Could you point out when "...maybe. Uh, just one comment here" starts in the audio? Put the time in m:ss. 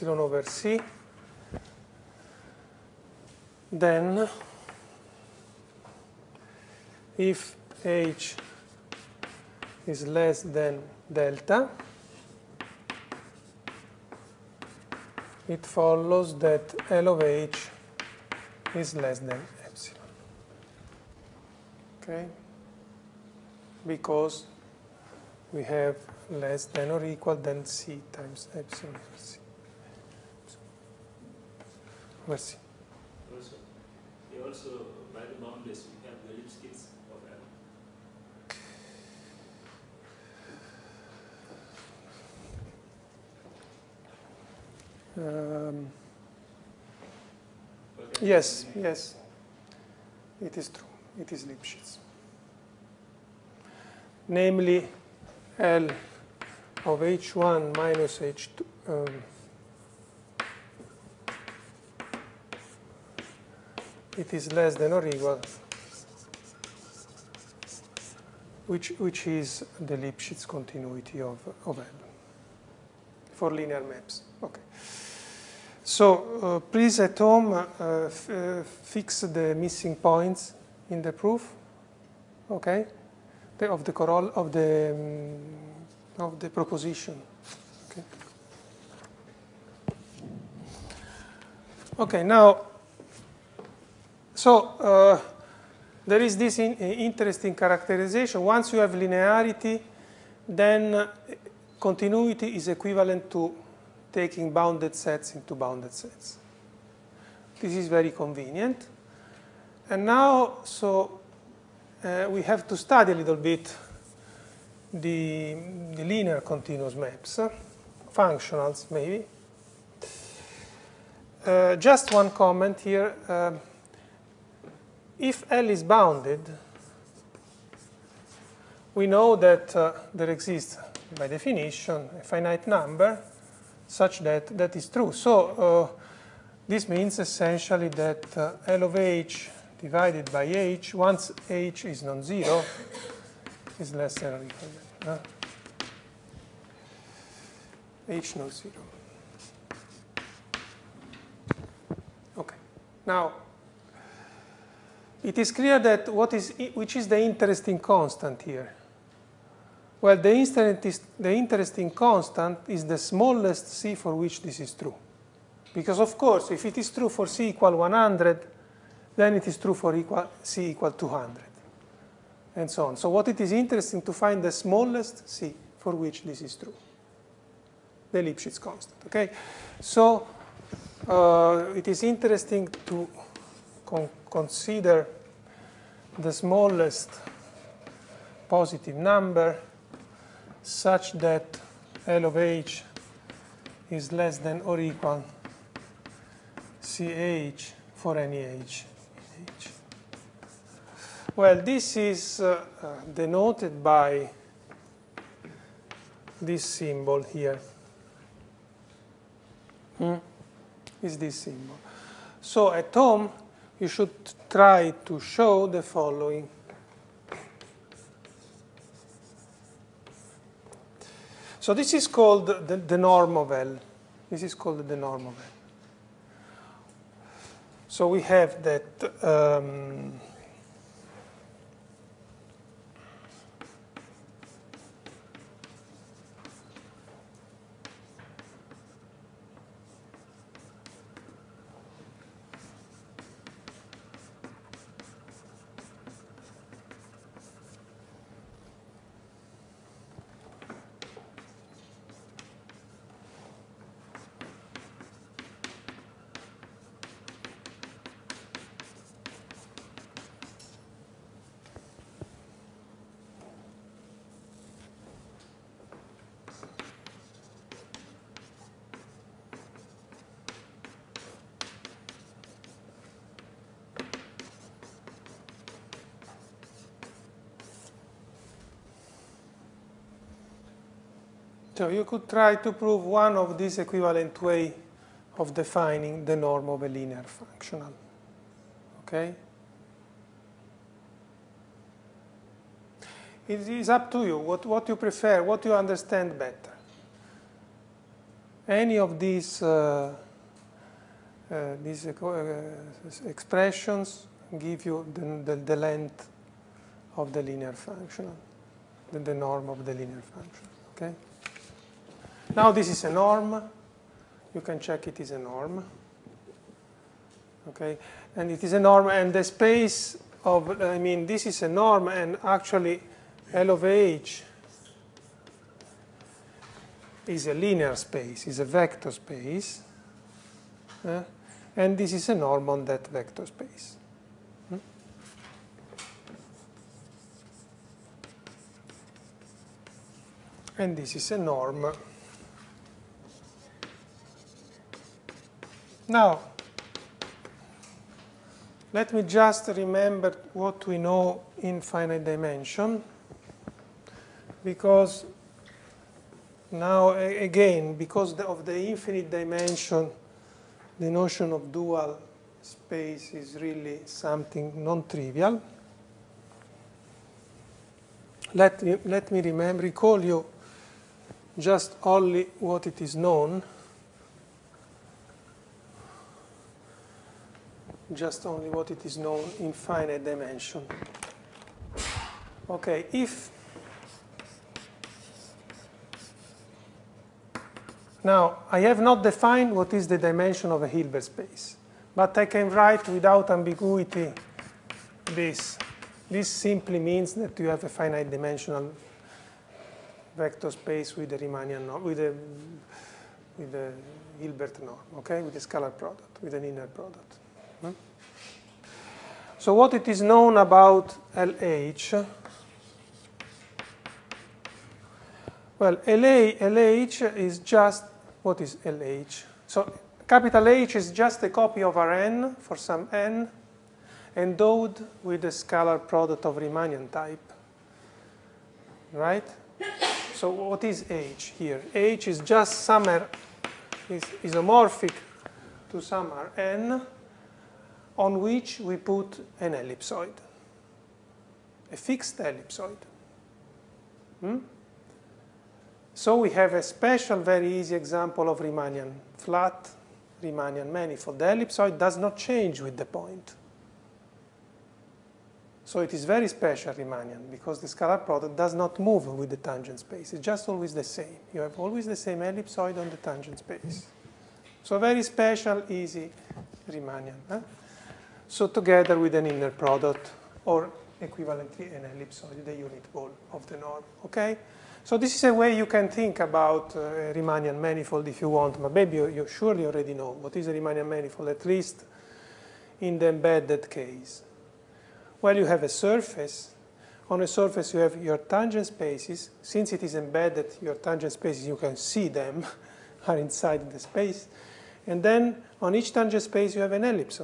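1:58.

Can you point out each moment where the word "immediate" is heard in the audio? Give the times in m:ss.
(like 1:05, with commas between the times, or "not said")
not said.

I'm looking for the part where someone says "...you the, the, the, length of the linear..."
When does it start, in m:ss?
5:04.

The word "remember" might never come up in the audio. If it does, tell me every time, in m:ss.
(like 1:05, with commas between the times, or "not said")
5:49, 6:09.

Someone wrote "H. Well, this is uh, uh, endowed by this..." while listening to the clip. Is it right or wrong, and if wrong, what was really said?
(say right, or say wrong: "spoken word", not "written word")
wrong: "denoted", not "endowed".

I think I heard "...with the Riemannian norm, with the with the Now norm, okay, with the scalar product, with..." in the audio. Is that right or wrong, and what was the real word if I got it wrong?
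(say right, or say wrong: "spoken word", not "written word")
wrong: "Hilbert", not "Now".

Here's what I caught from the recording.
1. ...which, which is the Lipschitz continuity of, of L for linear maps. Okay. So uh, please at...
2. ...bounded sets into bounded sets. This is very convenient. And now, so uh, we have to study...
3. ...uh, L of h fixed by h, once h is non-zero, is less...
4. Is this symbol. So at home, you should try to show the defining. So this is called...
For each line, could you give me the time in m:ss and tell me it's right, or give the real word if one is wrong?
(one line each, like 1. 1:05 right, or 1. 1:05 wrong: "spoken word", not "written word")
1. 1:08 right
2. 1:44 right
3. 2:18 wrong: "divided", not "fixed"
4. 3:31 wrong: "following", not "defining".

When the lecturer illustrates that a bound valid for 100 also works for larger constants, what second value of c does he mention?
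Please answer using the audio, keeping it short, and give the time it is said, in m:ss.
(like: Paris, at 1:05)
200, at 2:50.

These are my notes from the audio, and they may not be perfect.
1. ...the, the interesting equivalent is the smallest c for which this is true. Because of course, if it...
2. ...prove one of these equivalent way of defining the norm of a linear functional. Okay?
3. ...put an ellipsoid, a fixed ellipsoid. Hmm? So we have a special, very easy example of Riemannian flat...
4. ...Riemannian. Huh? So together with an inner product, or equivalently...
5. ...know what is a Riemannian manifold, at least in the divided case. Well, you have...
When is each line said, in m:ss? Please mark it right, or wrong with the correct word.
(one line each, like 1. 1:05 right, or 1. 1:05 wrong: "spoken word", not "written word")
1. 2:40 wrong: "constant", not "equivalent"
2. 4:42 right
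3. 7:18 right
4. 7:46 right
5. 8:00 wrong: "embedded", not "divided".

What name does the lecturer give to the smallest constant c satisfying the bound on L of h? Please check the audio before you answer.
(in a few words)
the Lipschitz constant.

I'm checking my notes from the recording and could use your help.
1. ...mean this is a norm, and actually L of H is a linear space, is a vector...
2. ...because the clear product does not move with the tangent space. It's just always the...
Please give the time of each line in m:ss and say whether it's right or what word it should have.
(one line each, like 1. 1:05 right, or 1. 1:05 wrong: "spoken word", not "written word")
1. 5:20 right
2. 7:37 wrong: "scalar", not "clear".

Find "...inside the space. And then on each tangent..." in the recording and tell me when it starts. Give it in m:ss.
8:13.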